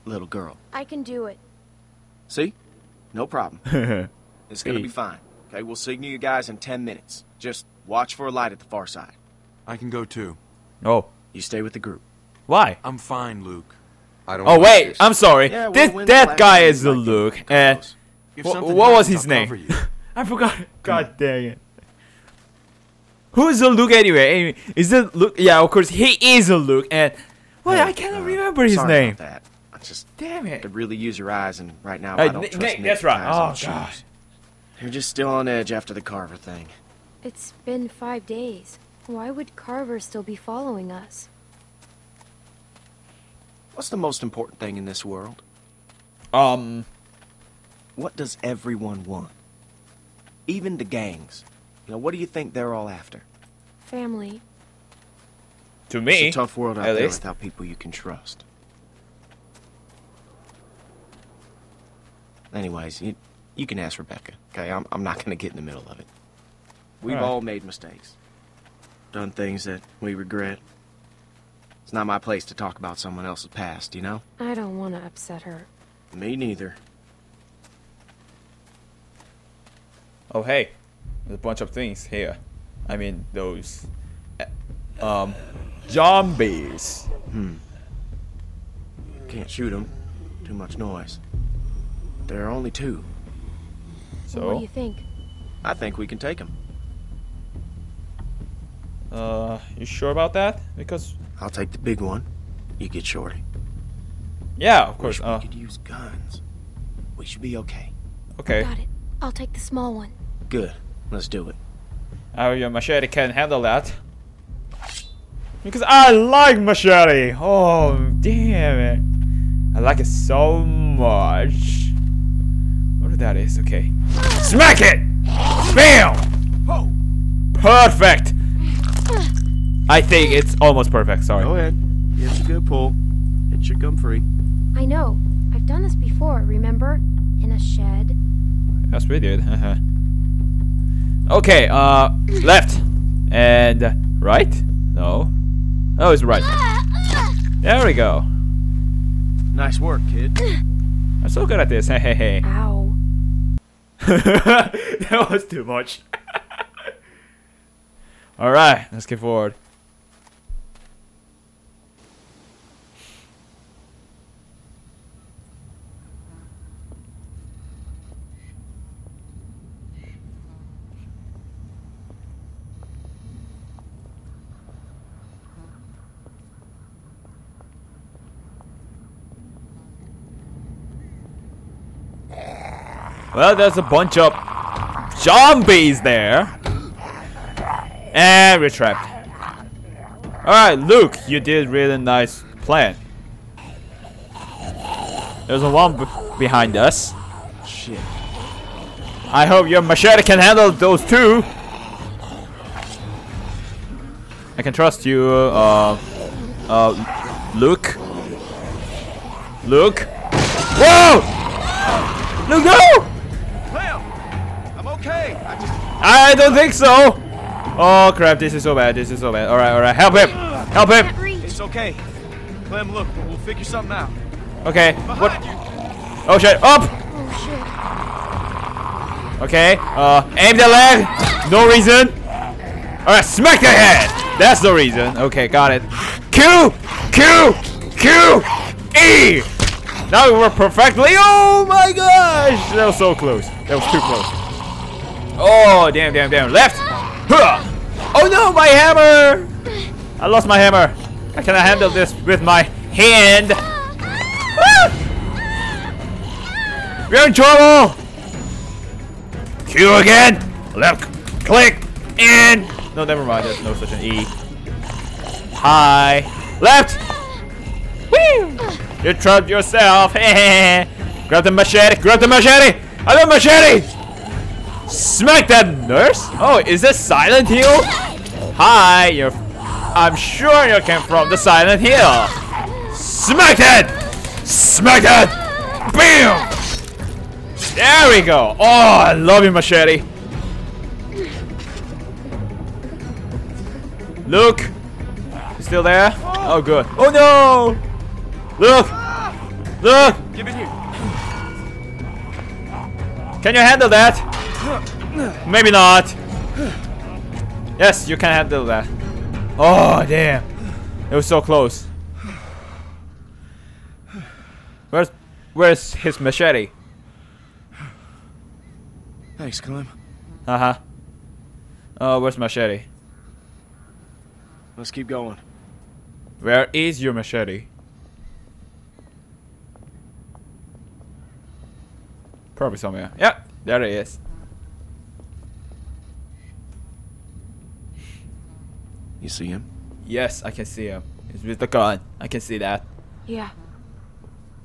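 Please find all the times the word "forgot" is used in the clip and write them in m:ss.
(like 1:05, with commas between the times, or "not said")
0:20.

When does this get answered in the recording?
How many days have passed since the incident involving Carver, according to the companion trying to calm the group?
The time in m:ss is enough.
0:37.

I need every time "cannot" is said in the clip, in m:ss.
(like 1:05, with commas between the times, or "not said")
0:27, 4:11.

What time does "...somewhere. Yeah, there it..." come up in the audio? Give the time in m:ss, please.
5:32.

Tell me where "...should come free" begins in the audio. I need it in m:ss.
2:13.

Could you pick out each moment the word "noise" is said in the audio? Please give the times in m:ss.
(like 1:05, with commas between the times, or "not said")
1:30.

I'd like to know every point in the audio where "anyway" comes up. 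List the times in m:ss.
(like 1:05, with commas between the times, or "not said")
0:23, 1:02.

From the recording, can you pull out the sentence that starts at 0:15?
Yeah, this, we'll that guy is the Luke.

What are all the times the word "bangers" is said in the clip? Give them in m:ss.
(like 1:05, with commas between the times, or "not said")
not said.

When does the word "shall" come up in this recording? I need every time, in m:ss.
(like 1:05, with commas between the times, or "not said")
not said.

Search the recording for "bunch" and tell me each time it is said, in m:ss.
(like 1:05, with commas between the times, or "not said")
1:21, 3:03.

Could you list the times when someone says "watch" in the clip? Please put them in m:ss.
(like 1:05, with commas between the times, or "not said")
0:07.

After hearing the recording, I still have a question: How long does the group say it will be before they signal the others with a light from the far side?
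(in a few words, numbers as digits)
10 minutes.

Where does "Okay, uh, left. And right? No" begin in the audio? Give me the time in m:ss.
2:21.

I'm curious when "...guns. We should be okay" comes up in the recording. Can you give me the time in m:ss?
1:45.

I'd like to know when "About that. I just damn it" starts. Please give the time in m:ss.
0:29.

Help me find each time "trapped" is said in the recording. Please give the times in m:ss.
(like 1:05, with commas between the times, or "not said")
3:08, 4:29.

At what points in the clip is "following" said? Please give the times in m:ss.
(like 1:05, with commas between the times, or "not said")
0:40.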